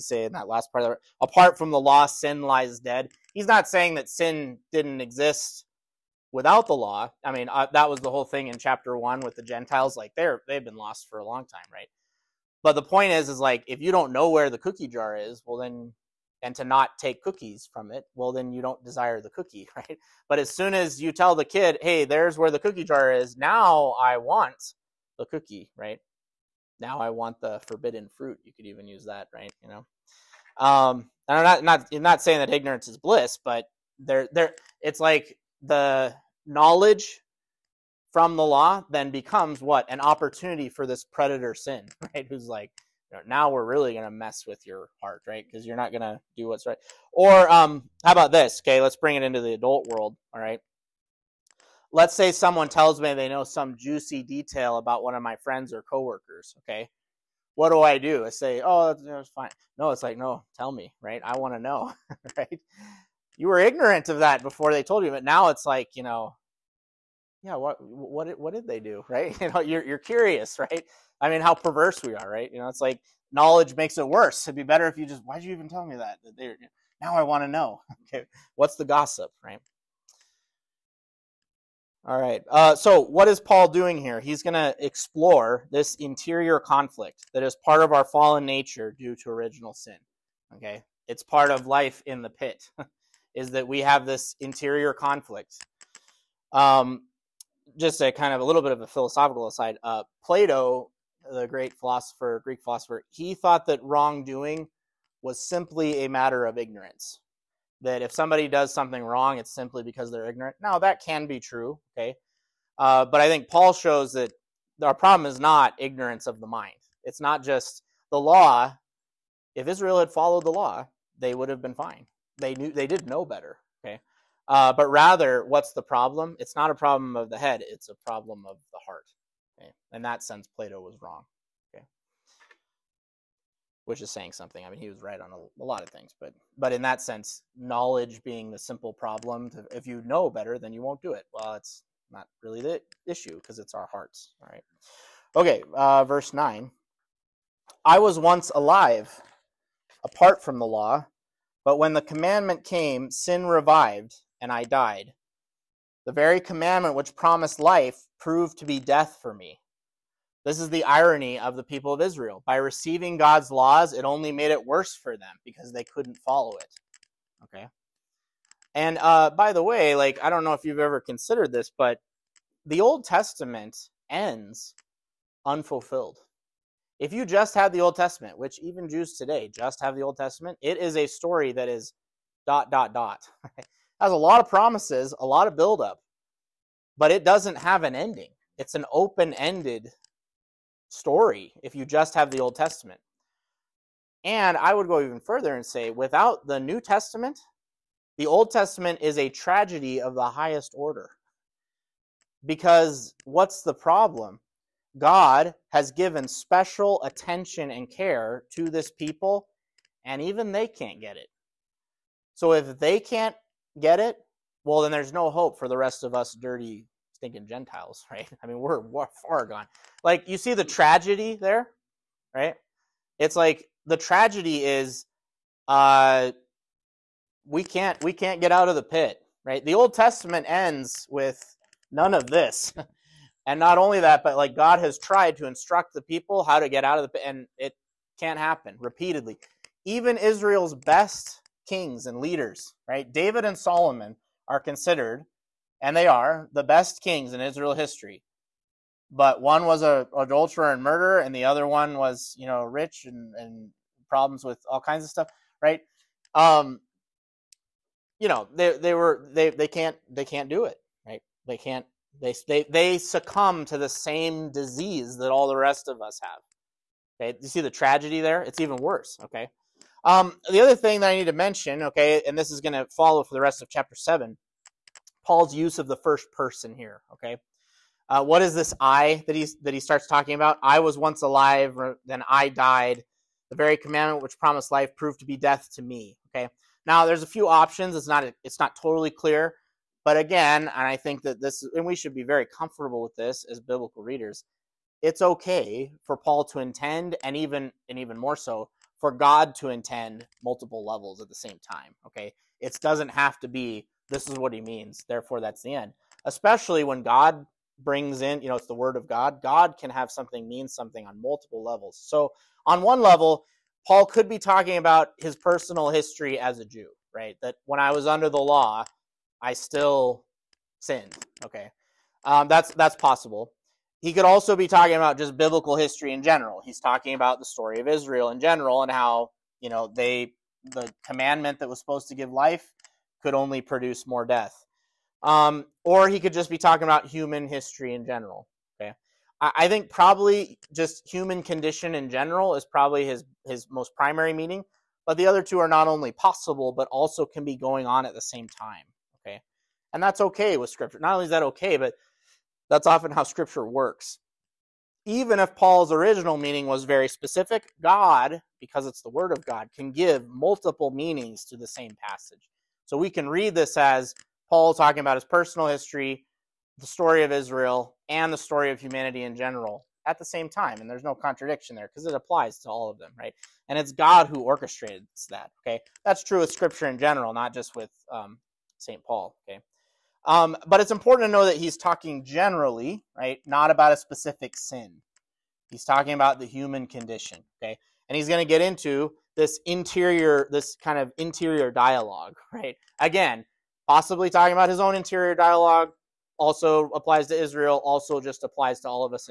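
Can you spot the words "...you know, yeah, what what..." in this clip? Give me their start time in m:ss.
1:05.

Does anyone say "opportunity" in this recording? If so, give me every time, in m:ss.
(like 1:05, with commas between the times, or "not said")
0:39.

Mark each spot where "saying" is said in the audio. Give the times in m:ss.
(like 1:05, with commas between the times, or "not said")
0:03, 0:32, 2:14.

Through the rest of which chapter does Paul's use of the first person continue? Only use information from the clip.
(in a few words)
Chapter 7.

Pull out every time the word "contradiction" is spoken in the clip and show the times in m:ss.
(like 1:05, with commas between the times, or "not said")
6:11.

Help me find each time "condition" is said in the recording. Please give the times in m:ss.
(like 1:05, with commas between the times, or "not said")
5:41, 6:26.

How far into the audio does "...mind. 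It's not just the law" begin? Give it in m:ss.
1:56.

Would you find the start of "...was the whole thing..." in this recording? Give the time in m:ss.
0:07.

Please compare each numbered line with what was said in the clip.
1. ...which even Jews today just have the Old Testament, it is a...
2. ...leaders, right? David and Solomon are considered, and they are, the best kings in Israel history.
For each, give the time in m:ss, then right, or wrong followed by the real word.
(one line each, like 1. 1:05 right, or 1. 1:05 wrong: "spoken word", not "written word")
1. 2:58 right
2. 4:02 right.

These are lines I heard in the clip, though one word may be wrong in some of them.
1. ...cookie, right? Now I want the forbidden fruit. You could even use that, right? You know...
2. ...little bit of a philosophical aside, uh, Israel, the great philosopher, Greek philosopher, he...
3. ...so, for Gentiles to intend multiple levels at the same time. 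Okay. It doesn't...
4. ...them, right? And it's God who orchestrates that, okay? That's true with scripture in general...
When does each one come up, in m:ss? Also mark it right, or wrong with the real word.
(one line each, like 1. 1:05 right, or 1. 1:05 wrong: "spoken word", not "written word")
1. 0:25 right
2. 1:38 wrong: "Plato", not "Israel"
3. 4:58 wrong: "God", not "Gentiles"
4. 6:12 right.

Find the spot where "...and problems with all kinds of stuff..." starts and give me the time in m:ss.
4:13.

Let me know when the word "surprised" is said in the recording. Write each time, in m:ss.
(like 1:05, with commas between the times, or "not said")
not said.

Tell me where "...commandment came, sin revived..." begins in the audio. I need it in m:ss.
2:32.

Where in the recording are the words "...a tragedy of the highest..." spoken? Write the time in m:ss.
3:19.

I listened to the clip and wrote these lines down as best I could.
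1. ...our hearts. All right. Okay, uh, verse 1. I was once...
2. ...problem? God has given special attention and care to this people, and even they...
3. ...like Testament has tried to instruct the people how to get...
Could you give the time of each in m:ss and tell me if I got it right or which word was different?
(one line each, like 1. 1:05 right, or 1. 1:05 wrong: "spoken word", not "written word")
1. 2:23 wrong: "9", not "1"
2. 3:23 right
3. 3:54 wrong: "God", not "Testament".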